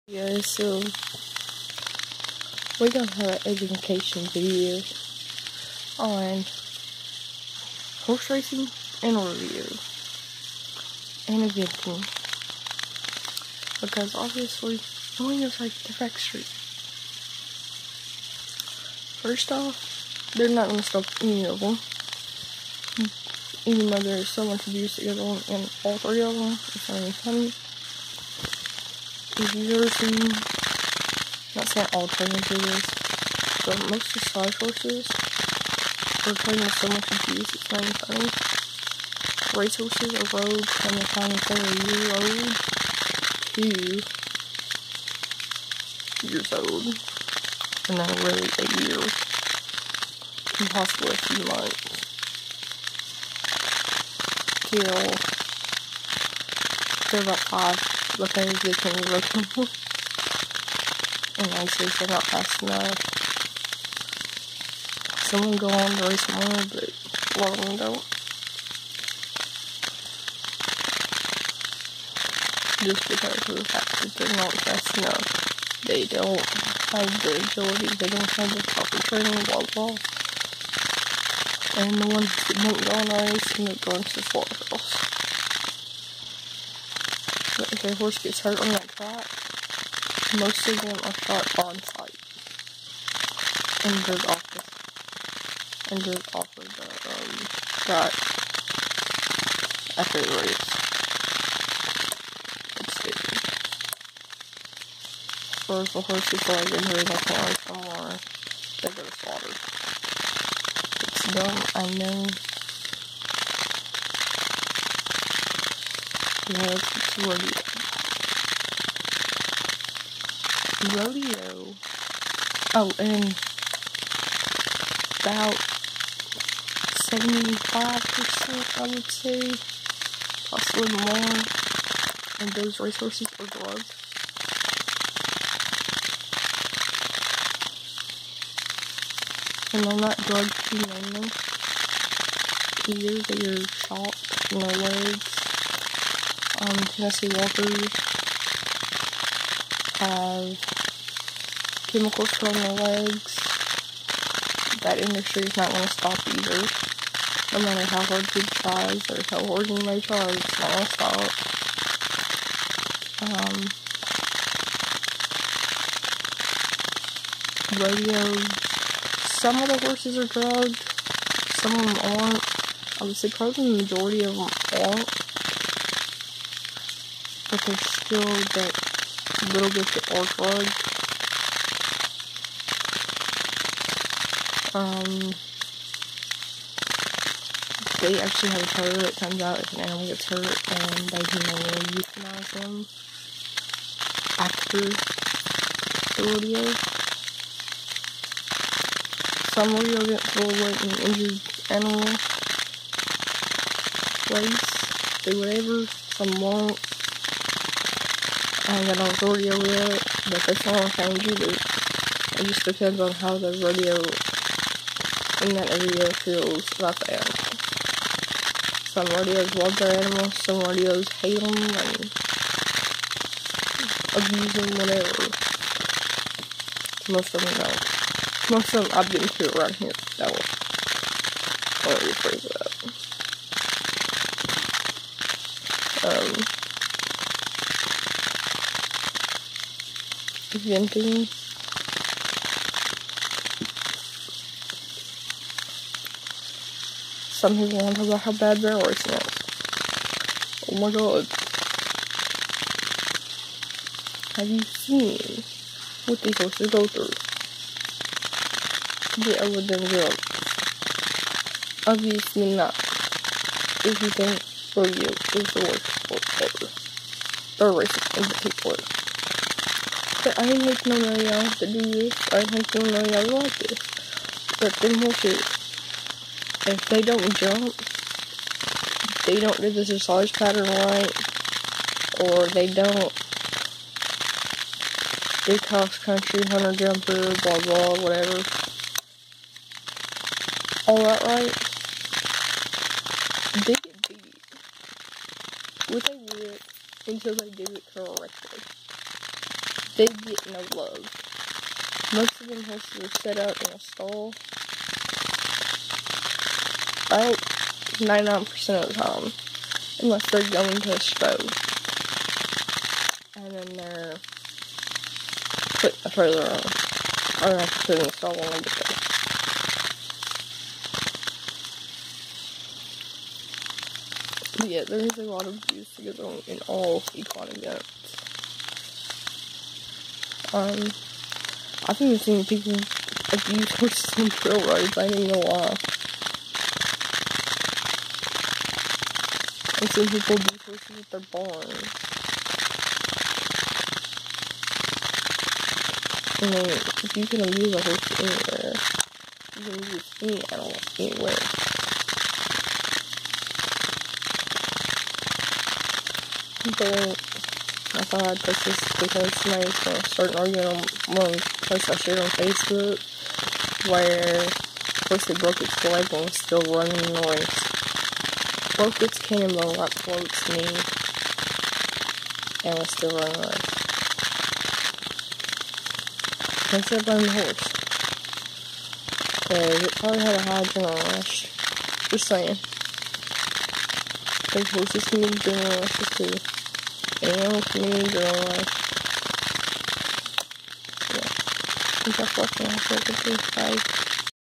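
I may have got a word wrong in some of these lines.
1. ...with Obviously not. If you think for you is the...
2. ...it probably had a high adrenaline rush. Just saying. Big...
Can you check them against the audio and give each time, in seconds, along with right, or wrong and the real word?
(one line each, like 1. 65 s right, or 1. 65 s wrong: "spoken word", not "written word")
1. 259 s right
2. 379 s right.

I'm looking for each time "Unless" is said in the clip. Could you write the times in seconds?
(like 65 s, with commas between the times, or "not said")
310 s.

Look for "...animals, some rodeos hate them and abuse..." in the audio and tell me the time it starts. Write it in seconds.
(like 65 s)
219 s.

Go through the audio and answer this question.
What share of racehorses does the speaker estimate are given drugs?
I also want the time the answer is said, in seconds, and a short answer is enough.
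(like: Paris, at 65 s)
75%, at 127 s.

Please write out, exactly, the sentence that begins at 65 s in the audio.
Someone go on to race more, but one of them don't.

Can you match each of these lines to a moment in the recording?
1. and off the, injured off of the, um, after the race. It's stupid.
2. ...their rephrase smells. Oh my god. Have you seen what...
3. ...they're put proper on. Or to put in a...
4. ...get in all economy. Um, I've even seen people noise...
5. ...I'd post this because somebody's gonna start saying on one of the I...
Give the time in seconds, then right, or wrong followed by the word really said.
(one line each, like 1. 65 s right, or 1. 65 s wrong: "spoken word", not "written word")
1. 93 s right
2. 248 s wrong: "horse", not "rephrase"
3. 313 s wrong: "further", not "proper"
4. 326 s wrong: "abuse", not "noise"
5. 358 s wrong: "arguing", not "saying".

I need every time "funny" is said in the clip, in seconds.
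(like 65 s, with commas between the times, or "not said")
27 s, 37 s.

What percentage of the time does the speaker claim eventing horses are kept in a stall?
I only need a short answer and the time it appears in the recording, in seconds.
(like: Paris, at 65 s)
99%, at 307 s.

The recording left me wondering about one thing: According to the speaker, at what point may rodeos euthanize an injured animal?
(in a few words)
After the rodeo.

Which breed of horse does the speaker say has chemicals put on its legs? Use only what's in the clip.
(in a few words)
Tennessee Walkers.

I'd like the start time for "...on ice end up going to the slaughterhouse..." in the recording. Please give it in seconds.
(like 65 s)
82 s.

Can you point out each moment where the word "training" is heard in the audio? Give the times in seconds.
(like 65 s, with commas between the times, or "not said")
32 s, 79 s.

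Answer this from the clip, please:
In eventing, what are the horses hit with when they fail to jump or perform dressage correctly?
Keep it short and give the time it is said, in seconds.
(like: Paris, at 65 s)
A whip, at 296 s.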